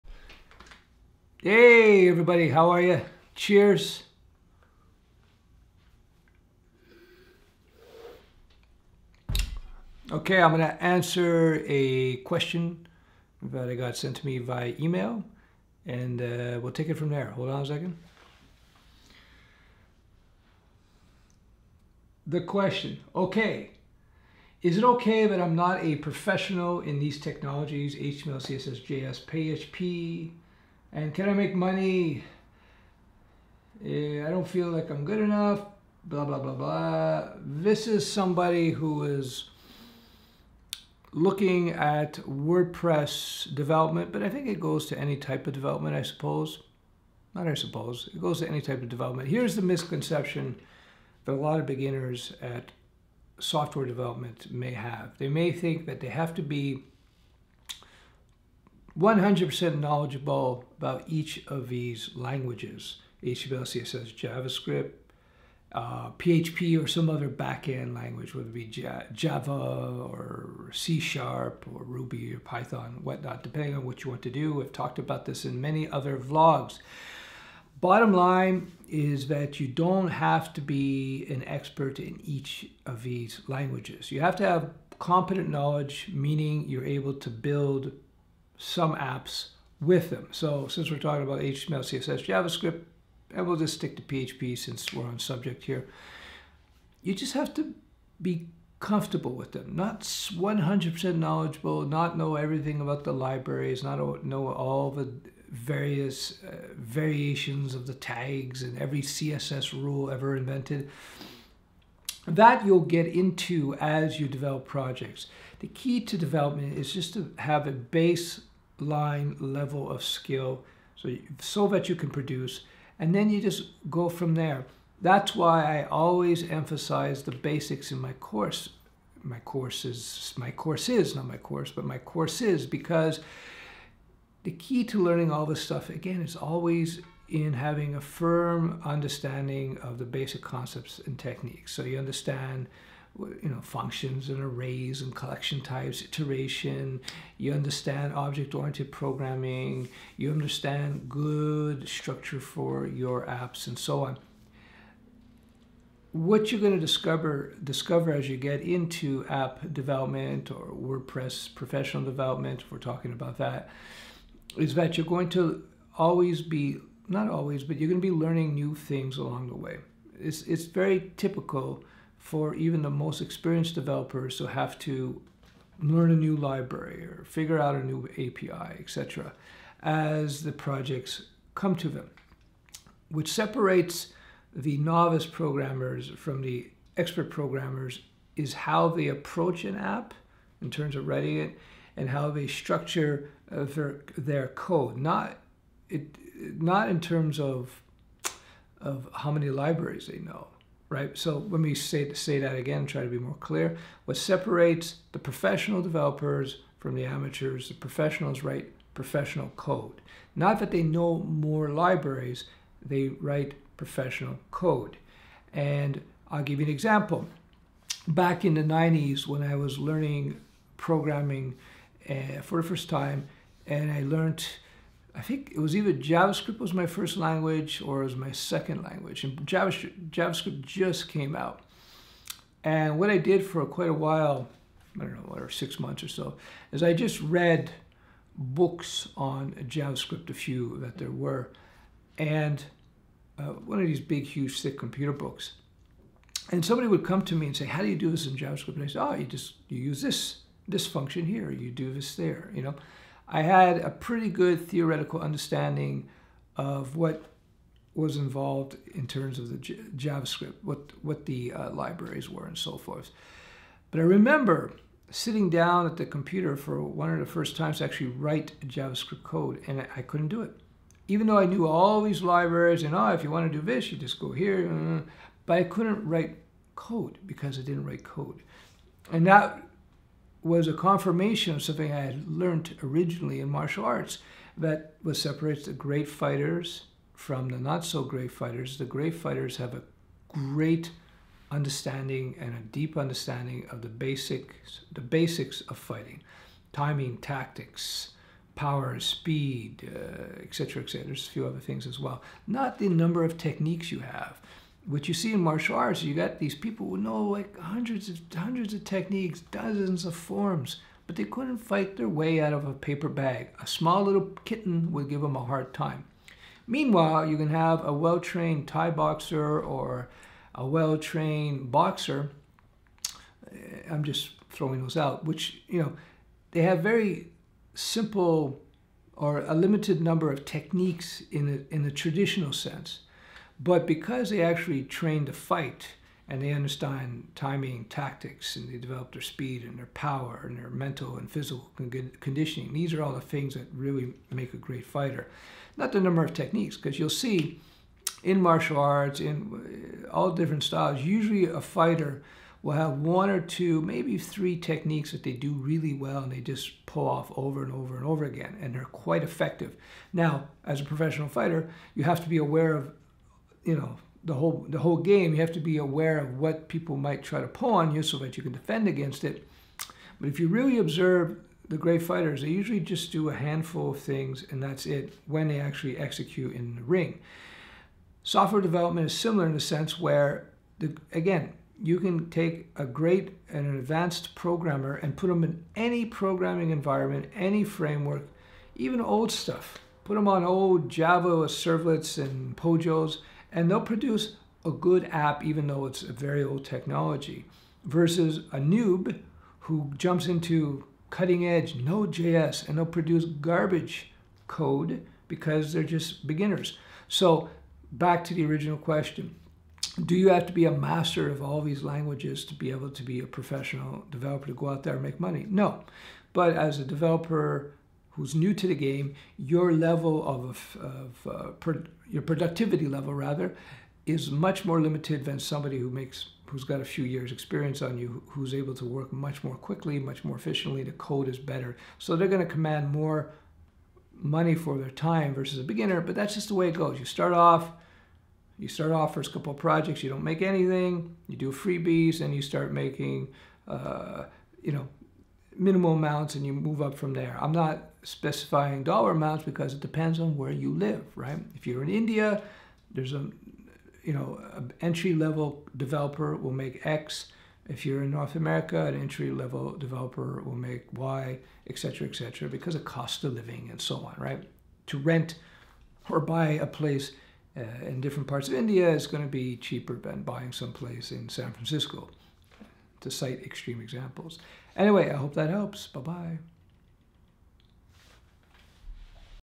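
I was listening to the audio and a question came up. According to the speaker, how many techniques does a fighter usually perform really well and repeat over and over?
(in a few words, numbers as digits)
one or two, maybe three.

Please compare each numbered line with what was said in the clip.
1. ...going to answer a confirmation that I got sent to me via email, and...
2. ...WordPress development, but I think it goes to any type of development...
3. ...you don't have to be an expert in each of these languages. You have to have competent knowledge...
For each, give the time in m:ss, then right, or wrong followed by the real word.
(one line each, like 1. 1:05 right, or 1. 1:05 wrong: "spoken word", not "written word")
1. 0:10 wrong: "question", not "confirmation"
2. 0:42 right
3. 1:19 right.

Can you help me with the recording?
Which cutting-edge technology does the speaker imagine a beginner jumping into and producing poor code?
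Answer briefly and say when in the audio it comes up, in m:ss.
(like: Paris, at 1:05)
Node.js, at 6:41.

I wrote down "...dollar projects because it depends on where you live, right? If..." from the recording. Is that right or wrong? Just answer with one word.
wrong.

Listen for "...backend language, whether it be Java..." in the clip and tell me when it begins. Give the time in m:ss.
1:07.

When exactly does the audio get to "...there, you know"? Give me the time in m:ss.
4:12.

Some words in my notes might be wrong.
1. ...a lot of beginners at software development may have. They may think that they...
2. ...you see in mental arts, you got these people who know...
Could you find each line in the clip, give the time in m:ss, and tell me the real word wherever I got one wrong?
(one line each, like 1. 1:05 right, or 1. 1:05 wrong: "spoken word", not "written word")
1. 0:51 right
2. 5:05 wrong: "martial", not "mental".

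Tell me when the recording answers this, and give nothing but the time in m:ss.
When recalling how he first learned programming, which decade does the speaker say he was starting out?
3:38.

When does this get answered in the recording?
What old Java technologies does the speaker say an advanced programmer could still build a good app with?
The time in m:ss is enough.
6:30.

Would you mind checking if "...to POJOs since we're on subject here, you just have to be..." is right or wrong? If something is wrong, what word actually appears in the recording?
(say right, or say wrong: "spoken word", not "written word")
wrong: "PHP", not "POJOs".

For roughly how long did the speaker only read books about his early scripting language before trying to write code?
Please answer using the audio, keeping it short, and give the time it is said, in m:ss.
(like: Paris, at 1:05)
six months, at 3:55.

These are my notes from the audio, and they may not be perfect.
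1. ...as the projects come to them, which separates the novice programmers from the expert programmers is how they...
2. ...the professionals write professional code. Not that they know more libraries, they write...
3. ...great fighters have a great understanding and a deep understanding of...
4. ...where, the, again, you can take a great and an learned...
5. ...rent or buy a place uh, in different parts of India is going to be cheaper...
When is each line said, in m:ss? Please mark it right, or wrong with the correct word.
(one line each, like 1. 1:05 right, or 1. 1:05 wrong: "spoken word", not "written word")
1. 2:59 right
2. 3:27 right
3. 4:48 right
4. 6:19 wrong: "advanced", not "learned"
5. 7:44 right.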